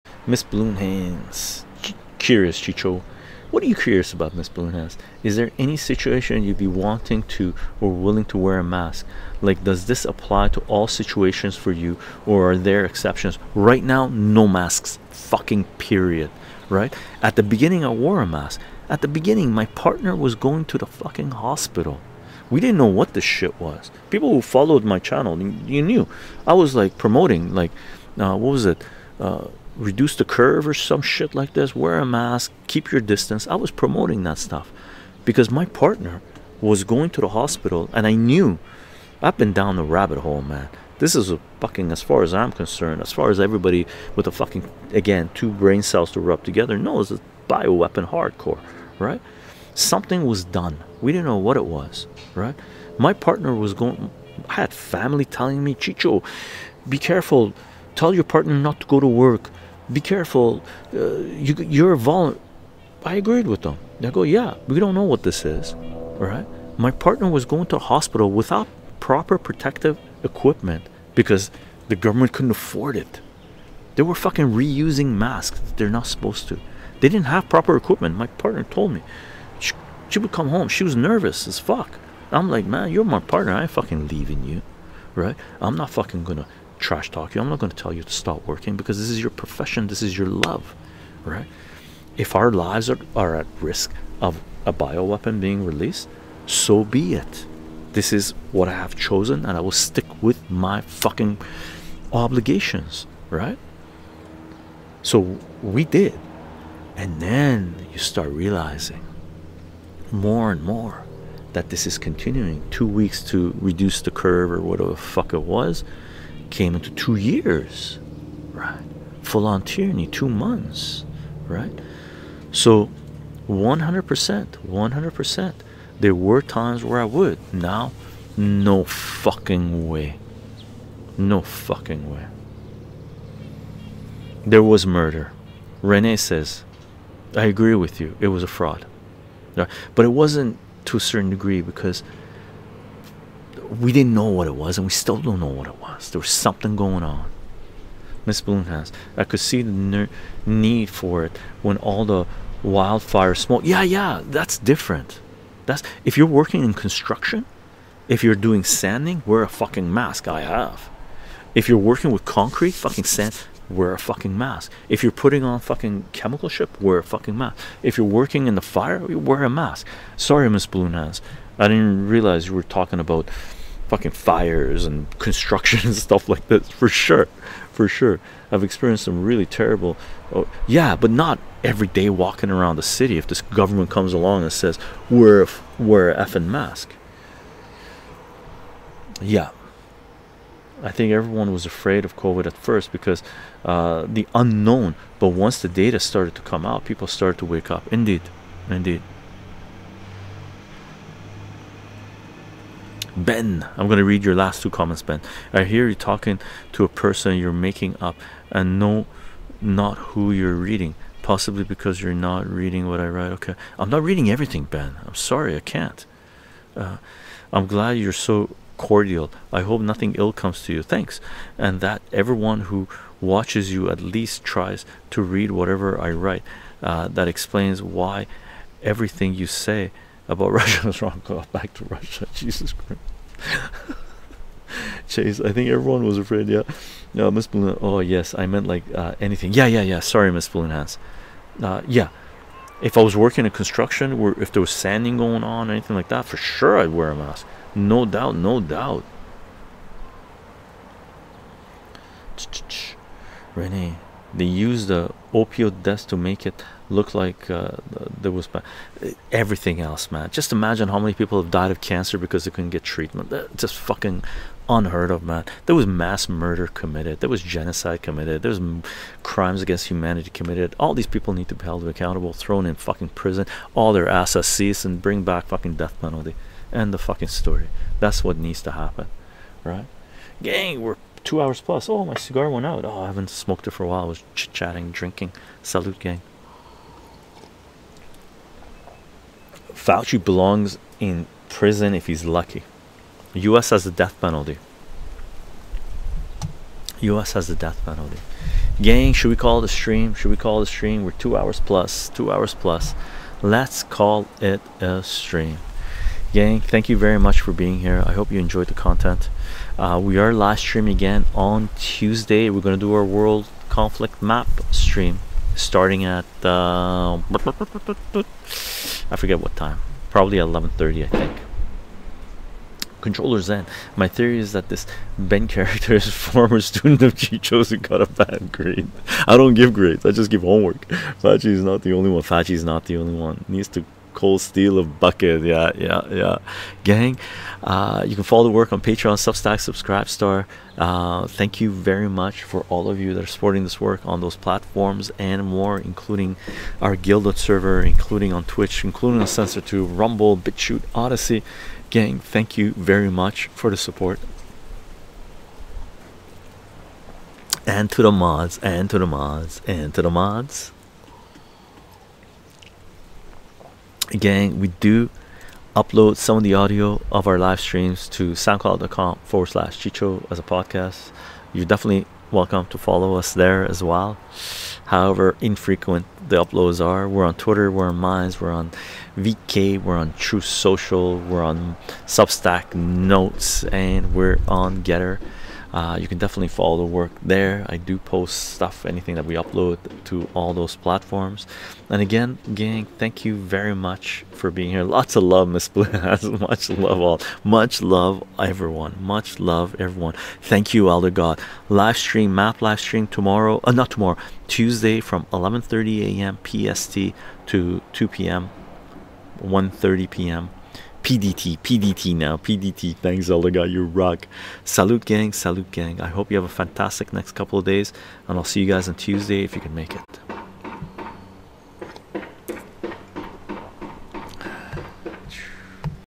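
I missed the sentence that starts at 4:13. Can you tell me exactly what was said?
Renee, they used the opioid deaths to make it look like uh, there was everything else, man.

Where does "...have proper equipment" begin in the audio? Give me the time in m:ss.
1:17.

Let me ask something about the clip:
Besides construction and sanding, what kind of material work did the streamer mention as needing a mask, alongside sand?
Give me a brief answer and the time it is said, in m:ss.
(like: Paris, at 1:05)
concrete, at 2:42.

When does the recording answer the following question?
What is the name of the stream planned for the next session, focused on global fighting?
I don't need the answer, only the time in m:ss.
5:13.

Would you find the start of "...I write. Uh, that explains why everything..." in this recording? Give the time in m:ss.
3:45.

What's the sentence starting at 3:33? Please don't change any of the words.
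Okay, I'm not reading everything, Ben.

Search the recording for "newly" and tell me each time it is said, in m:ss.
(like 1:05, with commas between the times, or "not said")
not said.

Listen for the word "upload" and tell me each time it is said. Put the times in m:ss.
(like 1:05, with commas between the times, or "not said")
6:05, 6:16, 6:29.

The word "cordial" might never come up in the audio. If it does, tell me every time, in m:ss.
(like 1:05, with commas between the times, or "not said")
3:38.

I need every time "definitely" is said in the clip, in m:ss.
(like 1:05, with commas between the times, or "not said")
6:11, 6:26.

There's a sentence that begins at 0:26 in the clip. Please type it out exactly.
I was like promoting, like, uh, what was it?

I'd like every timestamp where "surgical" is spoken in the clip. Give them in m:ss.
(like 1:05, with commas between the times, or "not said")
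not said.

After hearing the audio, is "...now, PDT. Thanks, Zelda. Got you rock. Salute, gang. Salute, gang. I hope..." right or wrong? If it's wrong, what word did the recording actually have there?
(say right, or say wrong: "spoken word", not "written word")
right.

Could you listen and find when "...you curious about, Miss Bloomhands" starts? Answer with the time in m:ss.
0:03.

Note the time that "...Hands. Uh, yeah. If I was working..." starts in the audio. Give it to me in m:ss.
4:00.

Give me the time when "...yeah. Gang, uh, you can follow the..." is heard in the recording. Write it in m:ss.
5:36.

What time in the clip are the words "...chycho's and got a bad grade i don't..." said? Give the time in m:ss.
5:27.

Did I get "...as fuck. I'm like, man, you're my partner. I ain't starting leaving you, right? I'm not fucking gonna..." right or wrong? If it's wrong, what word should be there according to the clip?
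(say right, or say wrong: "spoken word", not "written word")
wrong: "fucking", not "starting".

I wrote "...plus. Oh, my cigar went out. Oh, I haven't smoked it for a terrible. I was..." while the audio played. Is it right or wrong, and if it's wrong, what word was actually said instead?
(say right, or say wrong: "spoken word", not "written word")
wrong: "while", not "terrible".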